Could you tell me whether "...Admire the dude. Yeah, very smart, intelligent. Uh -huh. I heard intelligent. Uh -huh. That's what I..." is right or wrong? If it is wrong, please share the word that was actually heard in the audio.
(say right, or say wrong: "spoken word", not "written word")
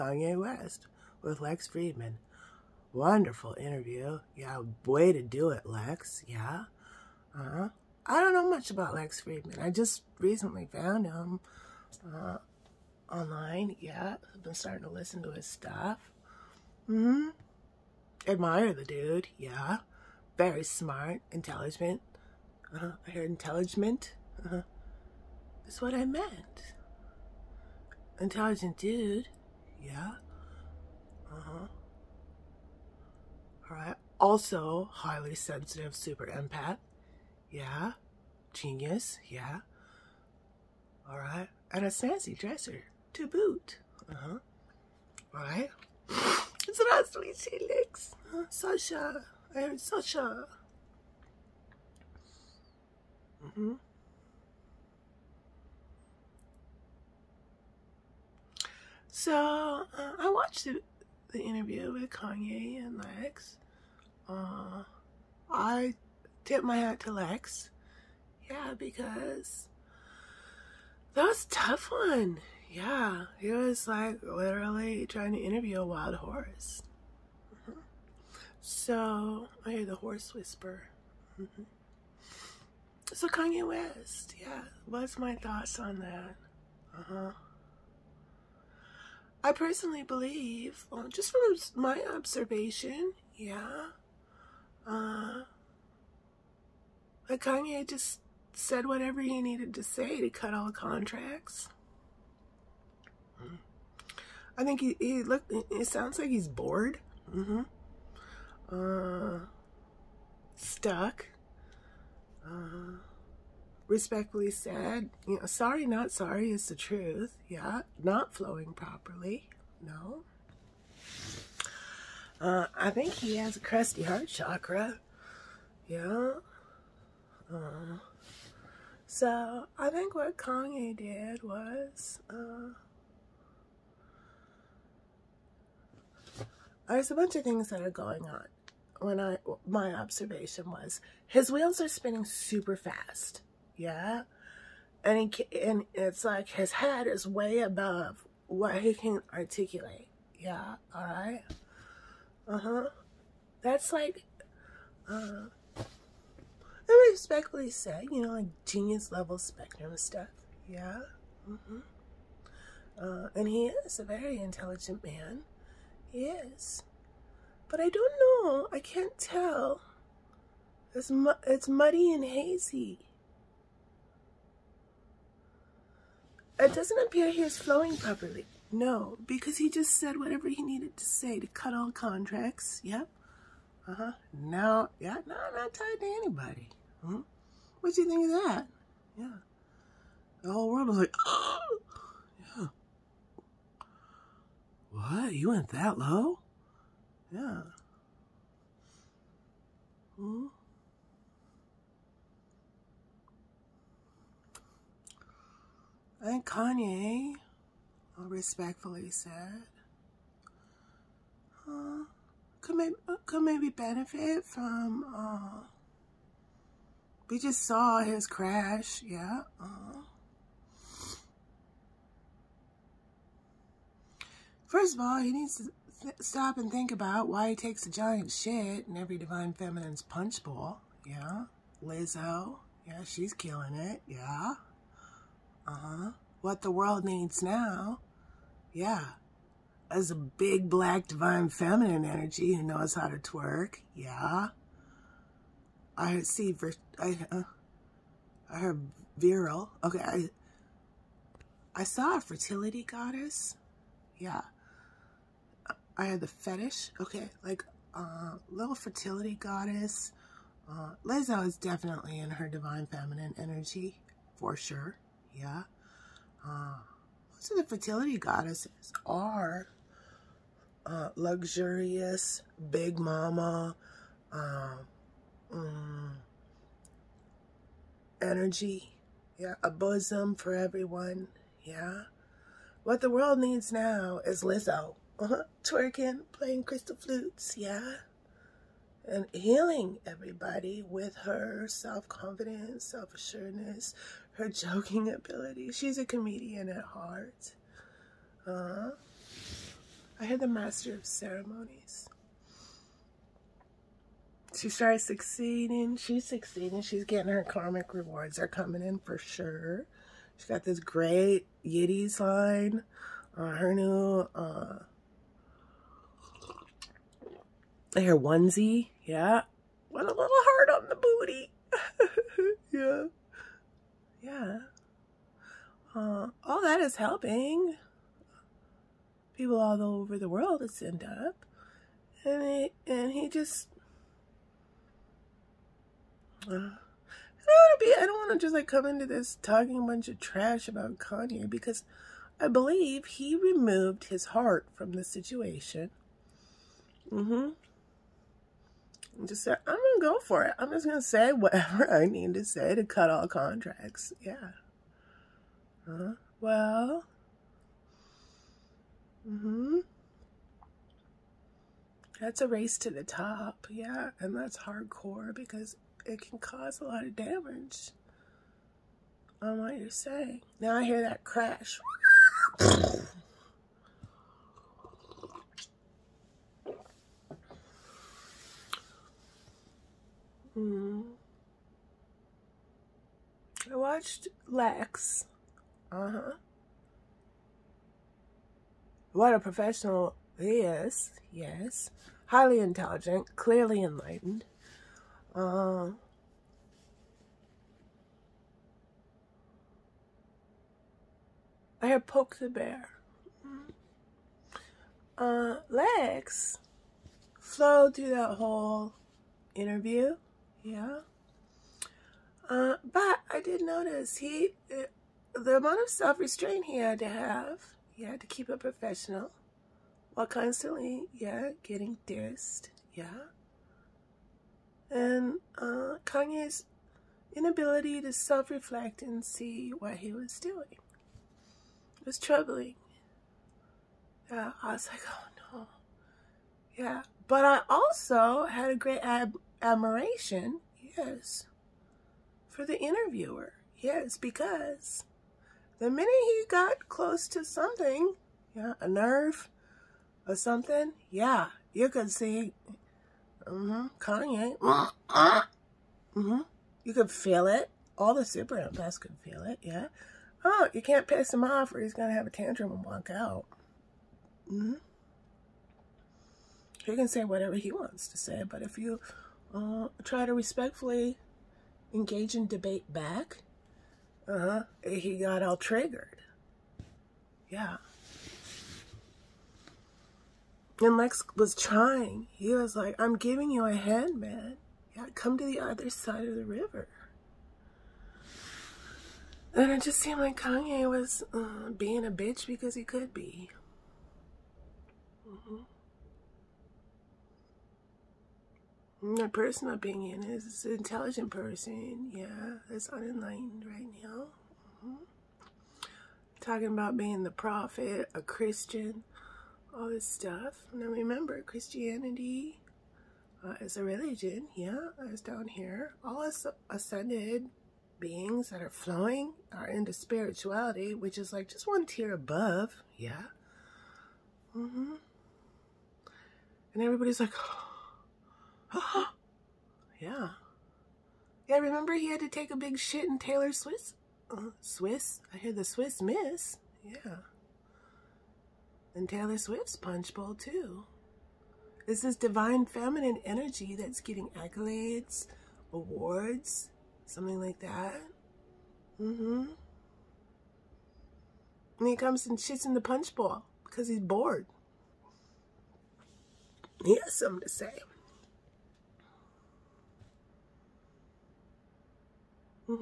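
right.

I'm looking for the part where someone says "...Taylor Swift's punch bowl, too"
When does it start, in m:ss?
8:59.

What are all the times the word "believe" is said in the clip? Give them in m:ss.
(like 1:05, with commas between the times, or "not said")
1:30, 5:42.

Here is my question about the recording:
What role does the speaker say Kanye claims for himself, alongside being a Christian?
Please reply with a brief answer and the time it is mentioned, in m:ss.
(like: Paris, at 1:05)
the prophet, at 8:27.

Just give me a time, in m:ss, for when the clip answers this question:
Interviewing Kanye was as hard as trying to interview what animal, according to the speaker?
1:15.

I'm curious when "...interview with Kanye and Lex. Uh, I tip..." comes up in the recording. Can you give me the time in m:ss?
1:01.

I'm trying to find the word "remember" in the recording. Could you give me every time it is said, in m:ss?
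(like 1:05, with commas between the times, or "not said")
8:30, 8:51.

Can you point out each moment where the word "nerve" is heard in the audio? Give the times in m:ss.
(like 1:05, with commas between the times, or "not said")
7:28.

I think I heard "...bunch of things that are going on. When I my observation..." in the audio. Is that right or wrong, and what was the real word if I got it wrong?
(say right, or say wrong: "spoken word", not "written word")
right.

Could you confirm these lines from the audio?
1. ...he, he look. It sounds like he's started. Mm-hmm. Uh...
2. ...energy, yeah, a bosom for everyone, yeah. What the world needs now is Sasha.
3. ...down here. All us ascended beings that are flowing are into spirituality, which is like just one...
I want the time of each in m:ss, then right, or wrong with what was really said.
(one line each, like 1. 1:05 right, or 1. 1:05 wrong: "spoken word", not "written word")
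1. 1:44 wrong: "bored", not "started"
2. 4:38 wrong: "Lizzo", not "Sasha"
3. 8:35 right.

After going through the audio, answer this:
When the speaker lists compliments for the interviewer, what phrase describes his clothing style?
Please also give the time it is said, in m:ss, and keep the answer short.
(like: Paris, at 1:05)
snazzy dresser, at 0:41.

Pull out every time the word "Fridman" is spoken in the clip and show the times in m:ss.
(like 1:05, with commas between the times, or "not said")
0:01, 0:09.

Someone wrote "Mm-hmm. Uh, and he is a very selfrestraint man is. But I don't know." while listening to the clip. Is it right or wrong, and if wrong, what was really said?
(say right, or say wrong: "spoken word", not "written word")
wrong: "intelligent", not "selfrestraint".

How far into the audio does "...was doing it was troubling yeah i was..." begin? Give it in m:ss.
7:10.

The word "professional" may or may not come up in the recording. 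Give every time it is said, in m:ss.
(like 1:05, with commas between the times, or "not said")
6:29, 6:58.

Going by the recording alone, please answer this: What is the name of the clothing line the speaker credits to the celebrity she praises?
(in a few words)
Yitty.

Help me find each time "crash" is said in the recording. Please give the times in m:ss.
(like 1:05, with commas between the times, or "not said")
3:38, 6:11.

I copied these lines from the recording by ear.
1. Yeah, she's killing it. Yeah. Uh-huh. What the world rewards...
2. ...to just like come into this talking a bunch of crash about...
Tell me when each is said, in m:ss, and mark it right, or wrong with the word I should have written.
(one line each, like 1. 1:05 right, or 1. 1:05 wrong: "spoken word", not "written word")
1. 3:52 wrong: "needs", not "rewards"
2. 5:38 wrong: "trash", not "crash".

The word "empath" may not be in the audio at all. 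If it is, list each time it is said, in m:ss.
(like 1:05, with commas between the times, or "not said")
0:36, 7:38.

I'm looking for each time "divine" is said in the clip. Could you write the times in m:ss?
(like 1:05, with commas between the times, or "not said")
3:49, 4:01, 4:22, 9:02.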